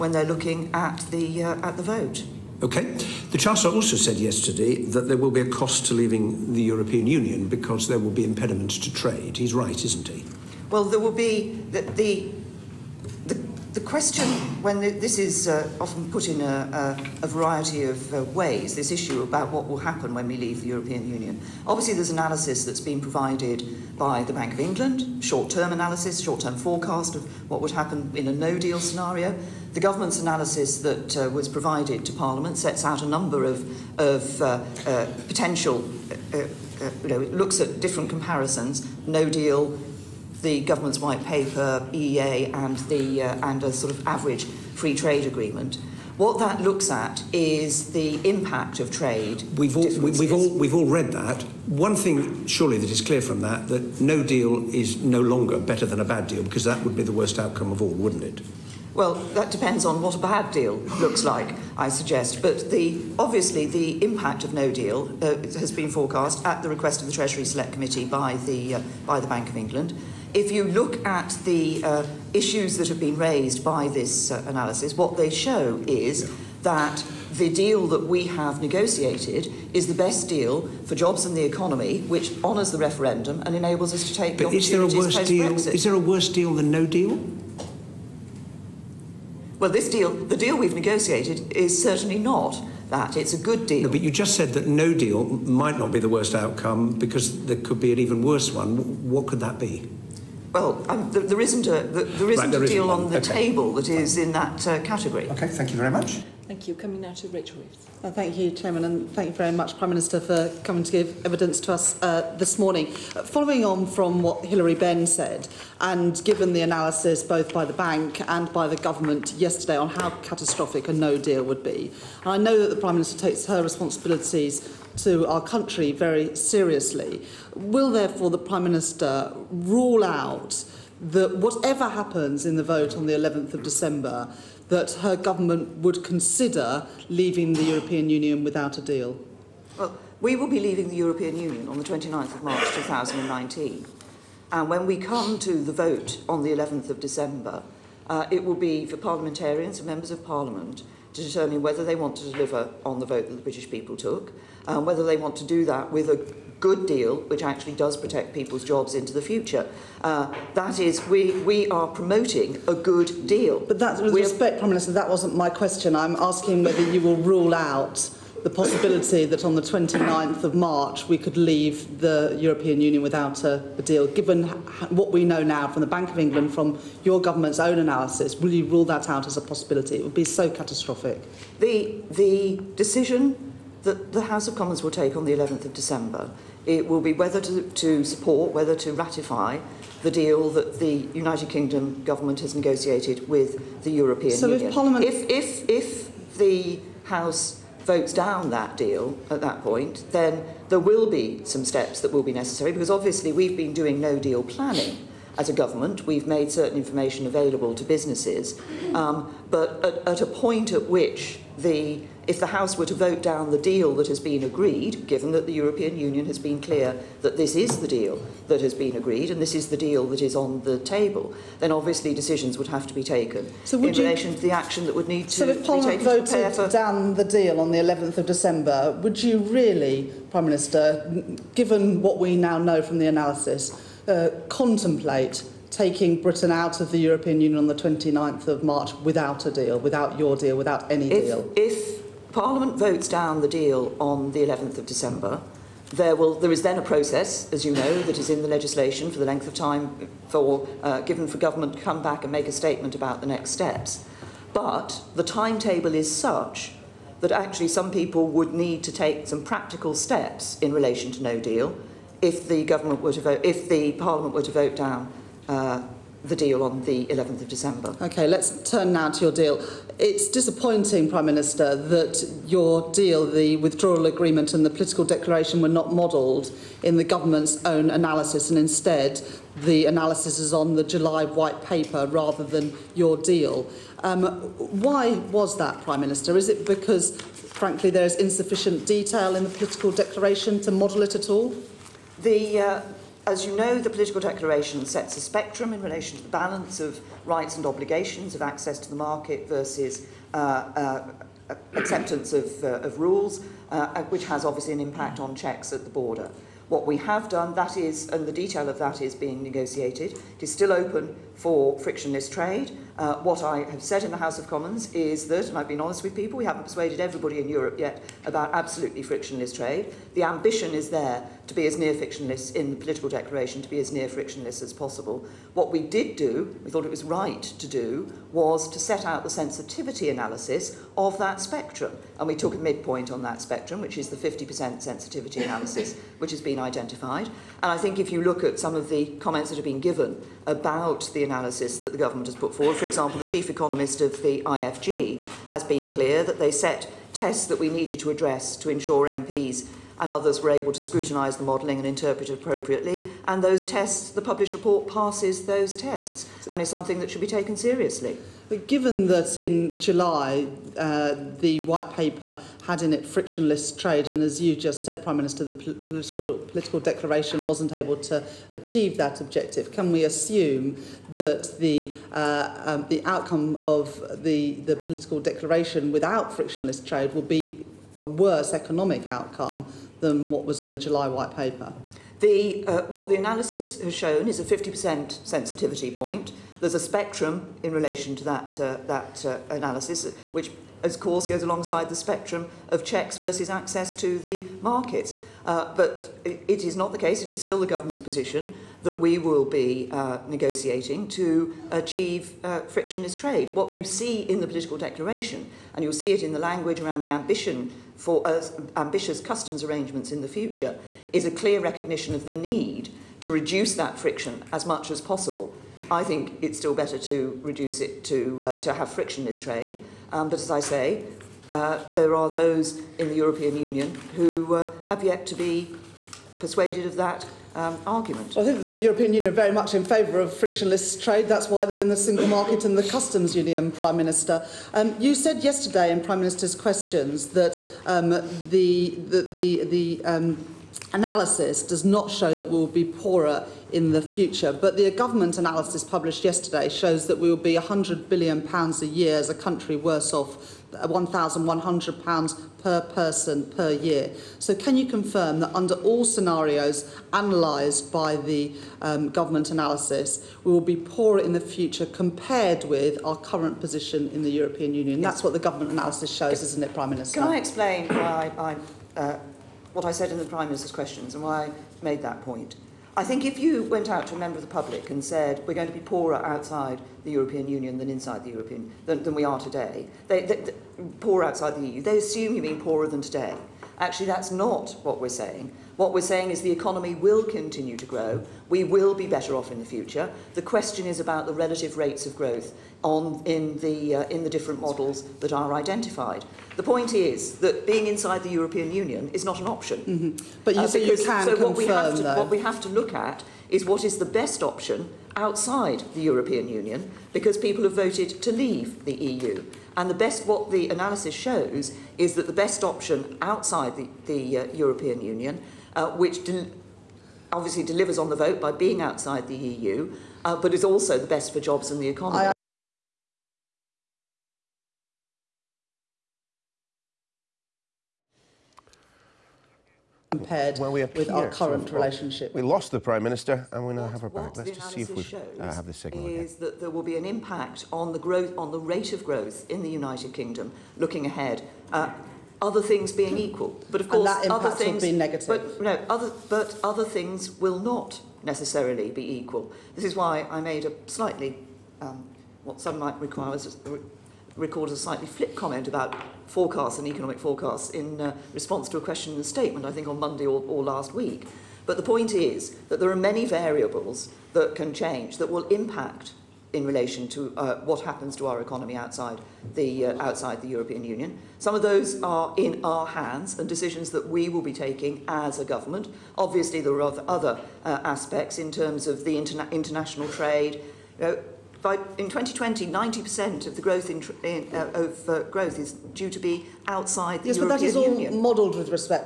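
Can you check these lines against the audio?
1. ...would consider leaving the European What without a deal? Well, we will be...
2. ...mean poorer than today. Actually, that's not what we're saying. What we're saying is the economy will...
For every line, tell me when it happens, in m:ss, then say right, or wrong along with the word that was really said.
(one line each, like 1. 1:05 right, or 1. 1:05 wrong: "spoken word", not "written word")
1. 2:15 wrong: "Union", not "What"
2. 8:02 right.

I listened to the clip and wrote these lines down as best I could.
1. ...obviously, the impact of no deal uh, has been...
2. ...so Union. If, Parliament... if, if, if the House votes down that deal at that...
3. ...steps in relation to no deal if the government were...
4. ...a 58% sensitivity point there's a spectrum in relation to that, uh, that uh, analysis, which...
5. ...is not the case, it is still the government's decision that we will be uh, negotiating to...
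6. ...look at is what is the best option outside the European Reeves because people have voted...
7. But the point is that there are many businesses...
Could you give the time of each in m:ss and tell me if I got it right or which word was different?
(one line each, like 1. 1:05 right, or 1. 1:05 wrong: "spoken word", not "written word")
1. 1:03 right
2. 3:14 right
3. 4:19 right
4. 6:24 wrong: "50", not "58"
5. 6:36 wrong: "position", not "decision"
6. 8:22 wrong: "Union", not "Reeves"
7. 9:21 wrong: "variables", not "businesses".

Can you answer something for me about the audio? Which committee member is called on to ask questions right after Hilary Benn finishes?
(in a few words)
Rachel Reeves.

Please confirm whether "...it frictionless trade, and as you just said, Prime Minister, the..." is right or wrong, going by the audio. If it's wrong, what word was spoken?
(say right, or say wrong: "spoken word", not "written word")
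right.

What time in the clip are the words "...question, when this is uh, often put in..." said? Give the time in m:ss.
0:13.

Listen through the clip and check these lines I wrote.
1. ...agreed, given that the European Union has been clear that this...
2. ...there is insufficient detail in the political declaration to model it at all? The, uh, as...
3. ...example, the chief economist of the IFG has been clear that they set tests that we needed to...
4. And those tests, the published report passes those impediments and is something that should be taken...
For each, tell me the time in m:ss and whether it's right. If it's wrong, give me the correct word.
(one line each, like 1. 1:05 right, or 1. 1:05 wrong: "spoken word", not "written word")
1. 3:34 right
2. 4:47 right
3. 5:42 right
4. 5:53 wrong: "tests", not "impediments".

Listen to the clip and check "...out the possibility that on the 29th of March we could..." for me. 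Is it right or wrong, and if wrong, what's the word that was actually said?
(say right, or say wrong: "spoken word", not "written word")
right.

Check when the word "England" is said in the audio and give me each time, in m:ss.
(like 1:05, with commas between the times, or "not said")
0:24, 1:09, 2:56.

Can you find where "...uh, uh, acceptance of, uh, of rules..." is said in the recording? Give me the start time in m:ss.
5:00.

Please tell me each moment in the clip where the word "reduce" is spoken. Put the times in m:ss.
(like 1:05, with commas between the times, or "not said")
6:53, 6:57.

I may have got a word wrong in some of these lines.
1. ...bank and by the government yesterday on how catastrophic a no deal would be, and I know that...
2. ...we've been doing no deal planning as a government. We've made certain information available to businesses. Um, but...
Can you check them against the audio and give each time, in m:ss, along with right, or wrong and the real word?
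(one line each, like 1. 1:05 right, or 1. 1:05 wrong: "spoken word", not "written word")
1. 1:57 right
2. 3:23 right.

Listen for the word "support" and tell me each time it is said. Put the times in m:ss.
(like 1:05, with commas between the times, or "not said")
3:08.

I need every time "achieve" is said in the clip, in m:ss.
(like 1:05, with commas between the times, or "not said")
6:08, 6:41.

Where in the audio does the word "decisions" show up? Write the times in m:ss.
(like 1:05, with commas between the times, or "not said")
3:02, 3:42, 9:33.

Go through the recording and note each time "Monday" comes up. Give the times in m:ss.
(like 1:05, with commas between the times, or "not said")
9:19.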